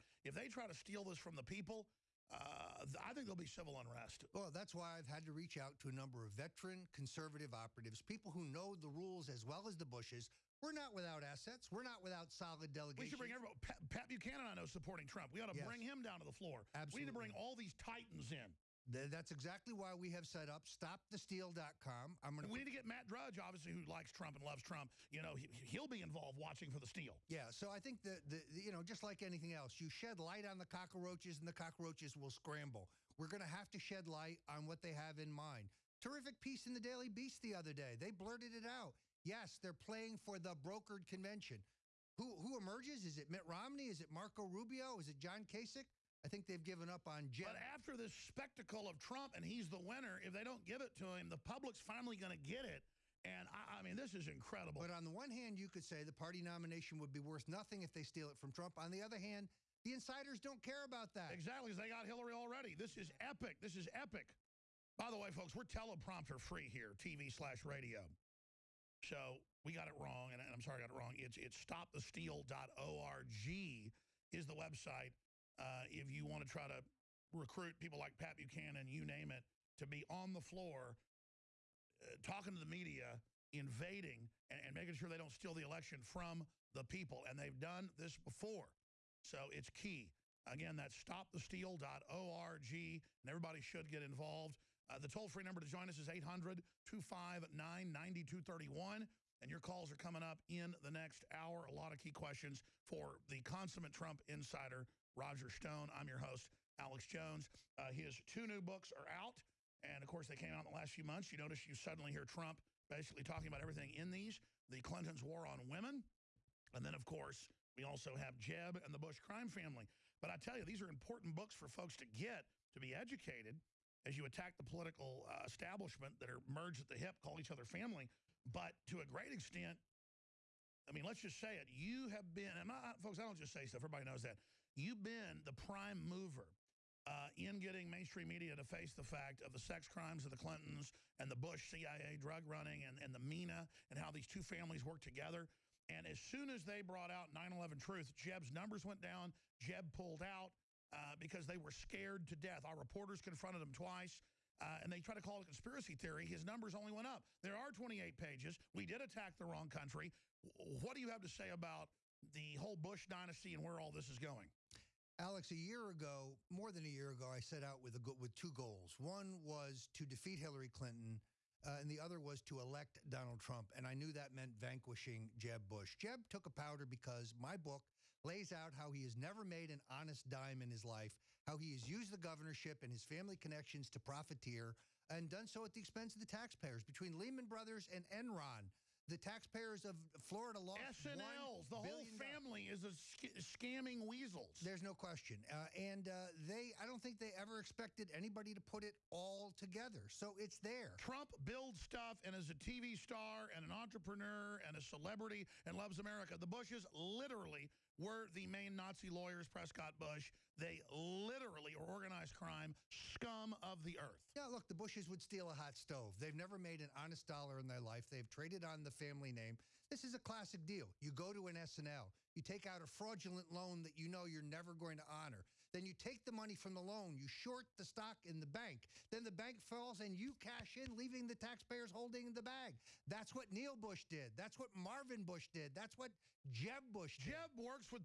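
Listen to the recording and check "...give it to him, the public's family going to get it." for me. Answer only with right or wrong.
wrong.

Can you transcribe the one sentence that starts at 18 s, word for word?
That's exactly why we have set up stopthesteal.com.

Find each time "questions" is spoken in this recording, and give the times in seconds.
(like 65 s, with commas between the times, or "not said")
102 s, 194 s.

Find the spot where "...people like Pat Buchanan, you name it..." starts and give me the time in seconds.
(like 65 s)
77 s.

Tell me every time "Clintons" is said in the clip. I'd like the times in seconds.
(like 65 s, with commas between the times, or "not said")
114 s, 140 s, 170 s.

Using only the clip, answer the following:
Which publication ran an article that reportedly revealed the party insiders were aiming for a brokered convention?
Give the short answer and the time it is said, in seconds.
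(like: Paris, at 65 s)
The Daily Beast, at 36 s.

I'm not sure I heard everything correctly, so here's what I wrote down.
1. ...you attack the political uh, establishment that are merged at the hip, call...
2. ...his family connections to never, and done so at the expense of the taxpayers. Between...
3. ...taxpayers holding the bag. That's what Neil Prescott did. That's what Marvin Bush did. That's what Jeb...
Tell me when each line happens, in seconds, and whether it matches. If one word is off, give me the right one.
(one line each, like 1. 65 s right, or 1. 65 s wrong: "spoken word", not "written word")
1. 124 s right
2. 182 s wrong: "profiteer", not "never"
3. 231 s wrong: "Bush", not "Prescott".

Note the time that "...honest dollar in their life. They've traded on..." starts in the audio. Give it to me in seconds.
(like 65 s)
216 s.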